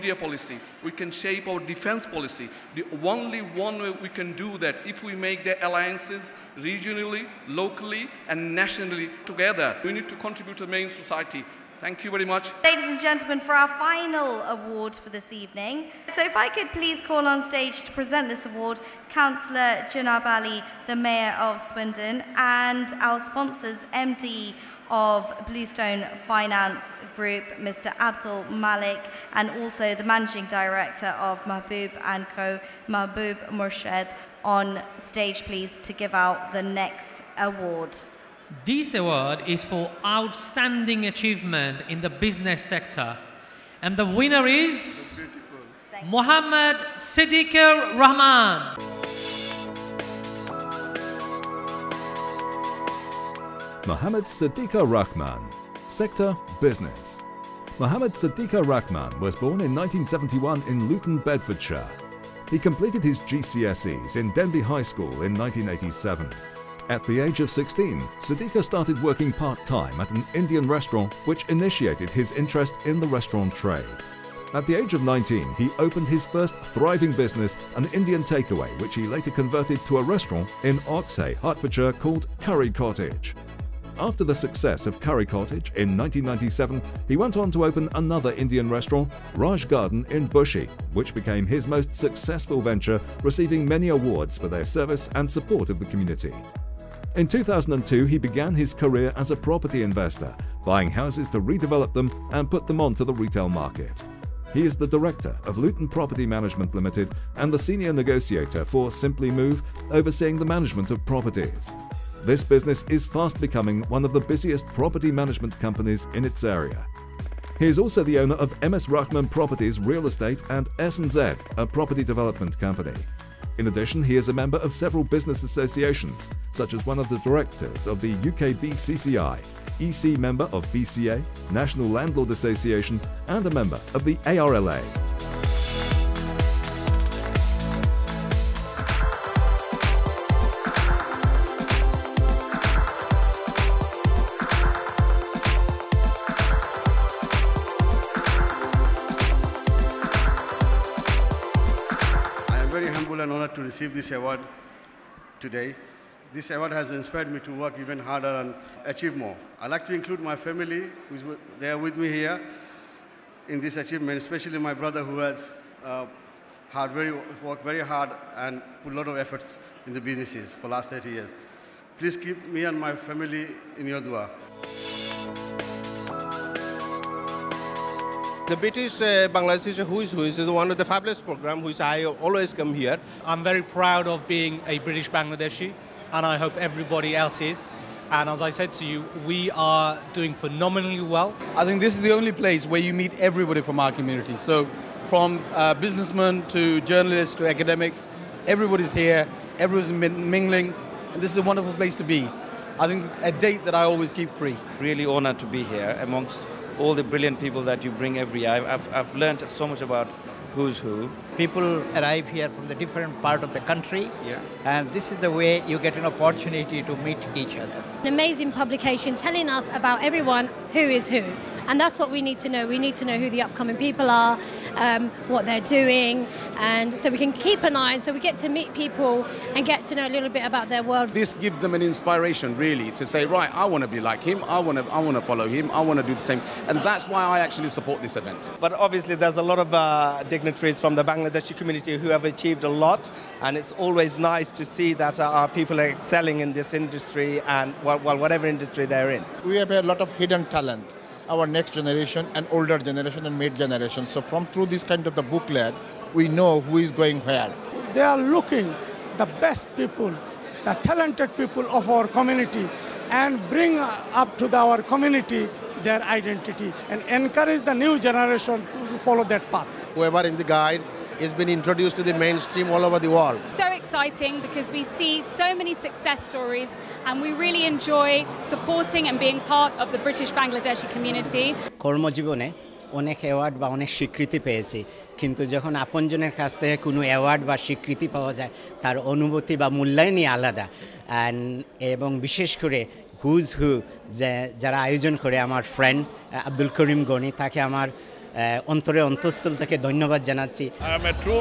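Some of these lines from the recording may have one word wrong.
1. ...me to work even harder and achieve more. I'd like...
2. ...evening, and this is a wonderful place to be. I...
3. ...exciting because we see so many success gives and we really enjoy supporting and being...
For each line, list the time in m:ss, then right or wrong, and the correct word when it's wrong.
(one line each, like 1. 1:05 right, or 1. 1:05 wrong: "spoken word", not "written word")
1. 2:37 right
2. 3:19 wrong: "mingling", not "evening"
3. 4:33 wrong: "stories", not "gives".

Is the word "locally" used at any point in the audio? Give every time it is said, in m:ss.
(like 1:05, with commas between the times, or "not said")
0:07.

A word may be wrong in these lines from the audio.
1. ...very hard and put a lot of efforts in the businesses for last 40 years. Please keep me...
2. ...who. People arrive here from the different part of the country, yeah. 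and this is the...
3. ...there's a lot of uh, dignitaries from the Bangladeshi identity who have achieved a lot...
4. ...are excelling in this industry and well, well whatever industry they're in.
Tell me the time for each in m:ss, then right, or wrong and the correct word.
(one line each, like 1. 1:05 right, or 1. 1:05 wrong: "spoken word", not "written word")
1. 2:47 wrong: "30", not "40"
2. 3:30 right
3. 3:59 wrong: "community", not "identity"
4. 4:05 right.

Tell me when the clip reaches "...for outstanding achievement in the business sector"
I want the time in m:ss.
0:39.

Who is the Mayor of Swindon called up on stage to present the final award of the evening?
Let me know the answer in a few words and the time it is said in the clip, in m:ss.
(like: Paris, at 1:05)
Junab Ali, at 0:19.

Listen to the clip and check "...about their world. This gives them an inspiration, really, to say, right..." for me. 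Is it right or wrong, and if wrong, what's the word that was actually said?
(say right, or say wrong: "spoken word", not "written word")
right.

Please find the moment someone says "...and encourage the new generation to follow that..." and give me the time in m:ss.
4:26.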